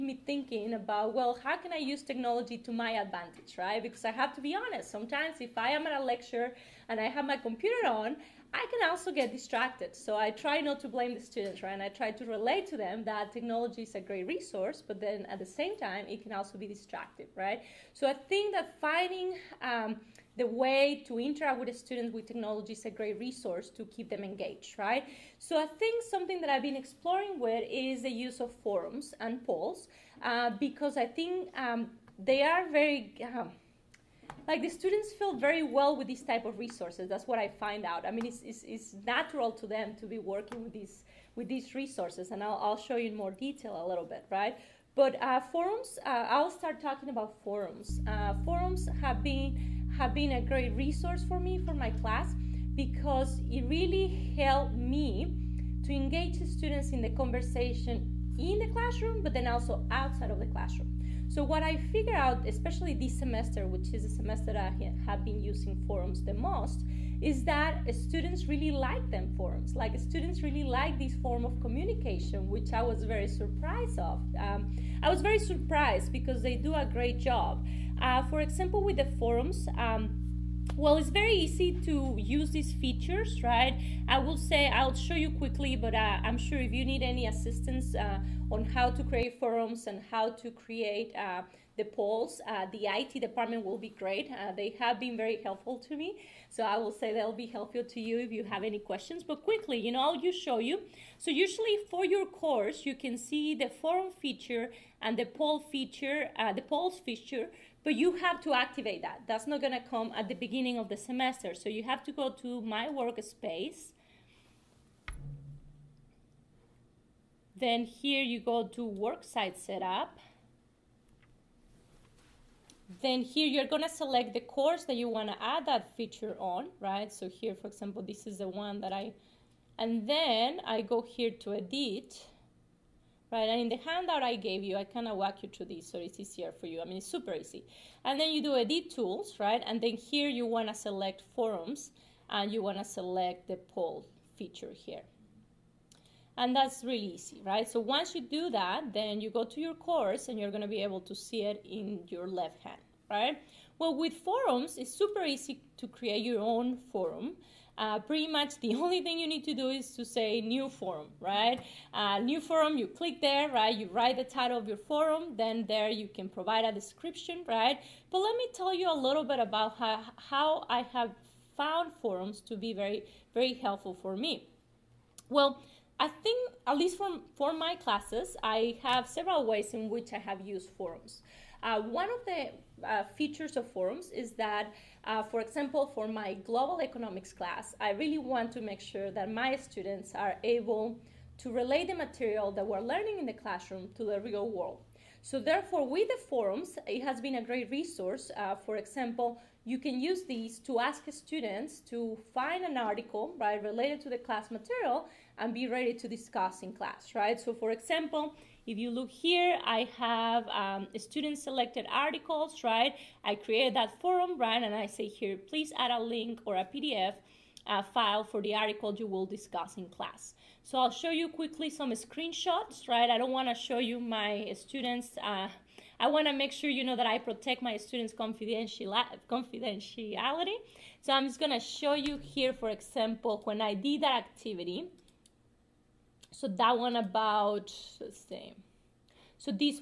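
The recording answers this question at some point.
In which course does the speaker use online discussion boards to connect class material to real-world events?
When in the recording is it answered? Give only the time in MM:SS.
03:06.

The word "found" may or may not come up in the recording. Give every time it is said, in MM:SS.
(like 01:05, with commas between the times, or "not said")
02:51.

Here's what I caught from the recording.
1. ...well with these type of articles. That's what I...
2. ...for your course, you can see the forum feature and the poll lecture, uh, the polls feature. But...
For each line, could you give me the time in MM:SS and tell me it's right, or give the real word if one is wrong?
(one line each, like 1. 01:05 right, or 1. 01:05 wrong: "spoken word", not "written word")
1. 00:35 wrong: "resources", not "articles"
2. 01:41 wrong: "feature", not "lecture".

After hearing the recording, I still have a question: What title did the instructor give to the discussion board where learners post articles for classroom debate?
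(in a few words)
student selected articles.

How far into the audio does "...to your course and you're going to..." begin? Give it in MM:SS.
02:29.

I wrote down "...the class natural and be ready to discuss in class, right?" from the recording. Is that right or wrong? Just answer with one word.
wrong.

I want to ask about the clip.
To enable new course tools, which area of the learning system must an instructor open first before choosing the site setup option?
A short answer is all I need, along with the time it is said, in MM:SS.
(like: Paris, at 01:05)
My Workspace, at 01:52.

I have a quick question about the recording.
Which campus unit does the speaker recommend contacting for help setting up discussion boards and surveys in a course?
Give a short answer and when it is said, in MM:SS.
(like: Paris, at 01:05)
IT department, at 01:32.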